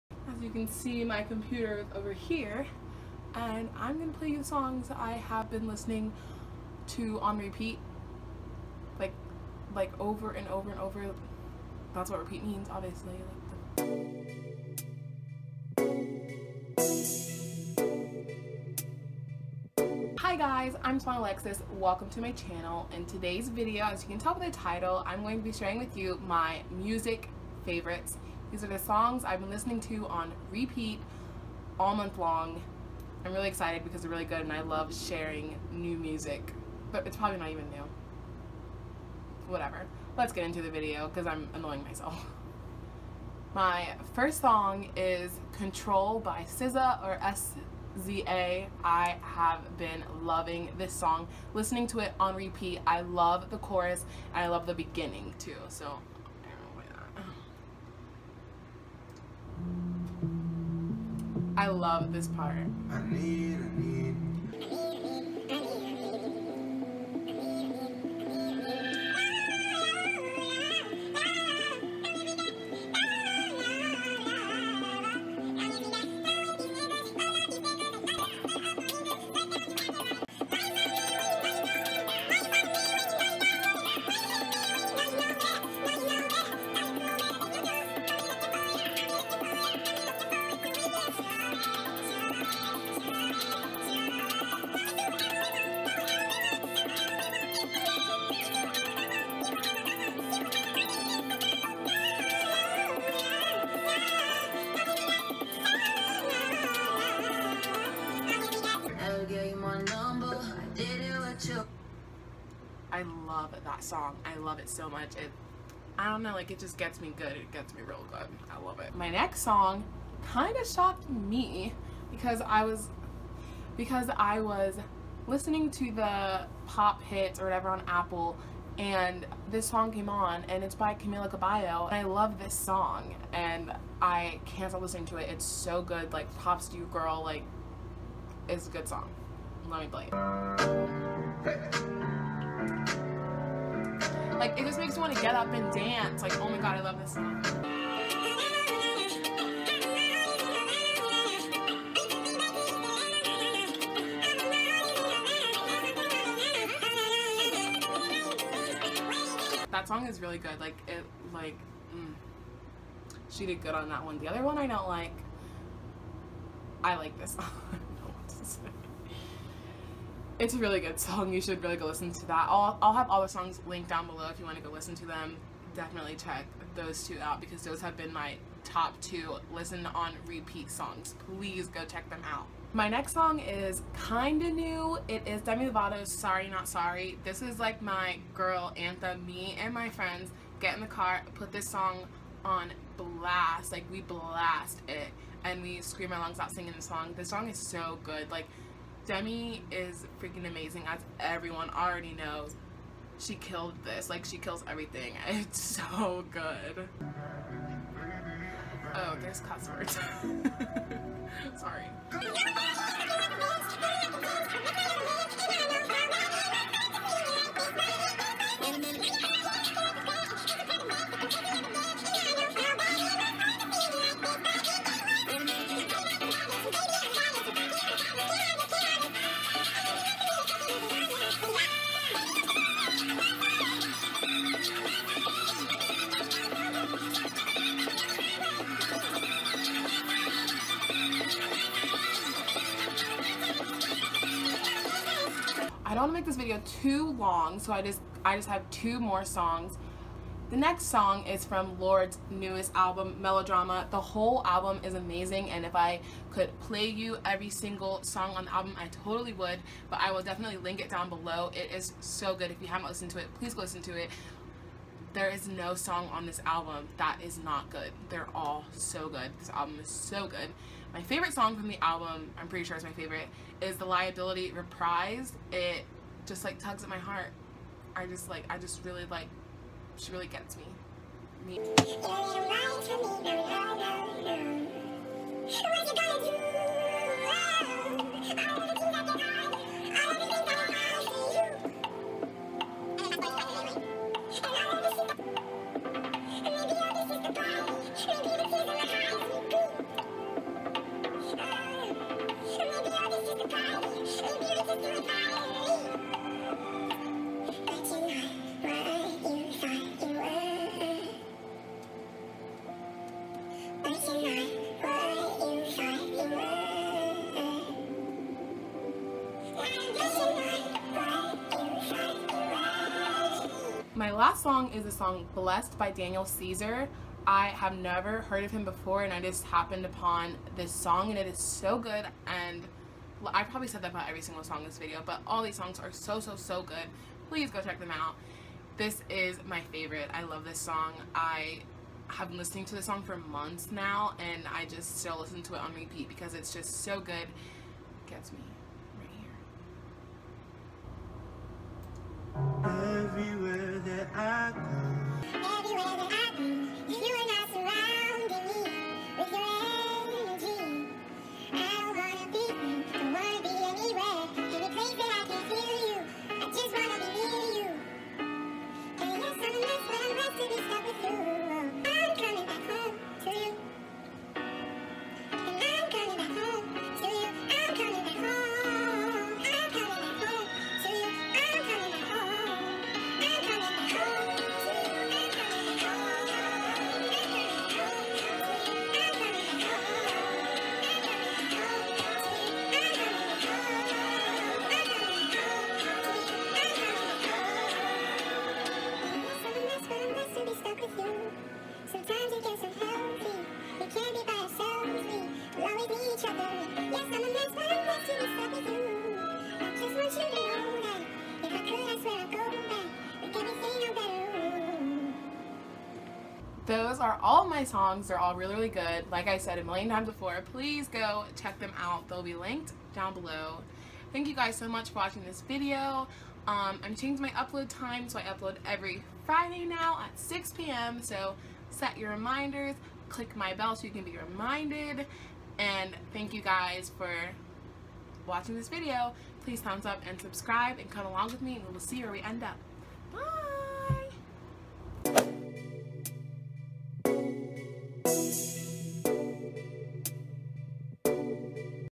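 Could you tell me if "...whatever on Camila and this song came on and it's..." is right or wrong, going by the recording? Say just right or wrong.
wrong.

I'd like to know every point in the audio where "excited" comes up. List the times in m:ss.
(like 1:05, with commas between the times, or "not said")
0:33.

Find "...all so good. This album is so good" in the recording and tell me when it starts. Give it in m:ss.
4:28.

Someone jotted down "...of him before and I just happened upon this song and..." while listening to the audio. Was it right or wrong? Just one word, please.
right.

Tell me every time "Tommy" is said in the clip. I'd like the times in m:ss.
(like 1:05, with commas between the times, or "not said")
not said.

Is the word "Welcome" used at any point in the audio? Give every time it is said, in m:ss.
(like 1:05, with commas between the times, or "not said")
0:21.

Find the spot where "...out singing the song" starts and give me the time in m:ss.
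3:16.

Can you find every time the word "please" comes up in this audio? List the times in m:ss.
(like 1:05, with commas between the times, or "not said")
3:01, 4:23, 5:37, 7:00, 7:19.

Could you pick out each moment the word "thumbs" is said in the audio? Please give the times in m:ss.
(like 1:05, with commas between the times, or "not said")
7:19.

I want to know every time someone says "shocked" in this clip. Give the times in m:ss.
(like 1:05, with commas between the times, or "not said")
2:00.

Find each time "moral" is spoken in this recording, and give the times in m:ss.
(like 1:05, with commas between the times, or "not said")
not said.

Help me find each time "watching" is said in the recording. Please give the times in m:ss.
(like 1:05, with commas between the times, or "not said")
7:04, 7:18.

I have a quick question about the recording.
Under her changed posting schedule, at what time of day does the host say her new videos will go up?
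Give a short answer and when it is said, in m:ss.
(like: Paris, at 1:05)
6 p.m., at 7:10.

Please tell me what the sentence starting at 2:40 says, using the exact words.
Like, it, like, mm, she did good on that one.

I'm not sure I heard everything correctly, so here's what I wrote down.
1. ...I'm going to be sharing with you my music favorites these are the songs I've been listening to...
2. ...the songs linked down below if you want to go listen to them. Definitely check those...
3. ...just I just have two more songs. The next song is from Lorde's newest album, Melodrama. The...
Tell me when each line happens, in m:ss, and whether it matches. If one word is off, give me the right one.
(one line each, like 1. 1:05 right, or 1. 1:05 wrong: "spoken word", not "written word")
1. 0:25 right
2. 2:53 right
3. 4:07 right.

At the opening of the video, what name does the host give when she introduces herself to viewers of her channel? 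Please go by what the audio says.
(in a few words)
SeVohn Alexis.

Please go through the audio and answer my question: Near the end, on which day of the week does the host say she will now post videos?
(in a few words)
Friday.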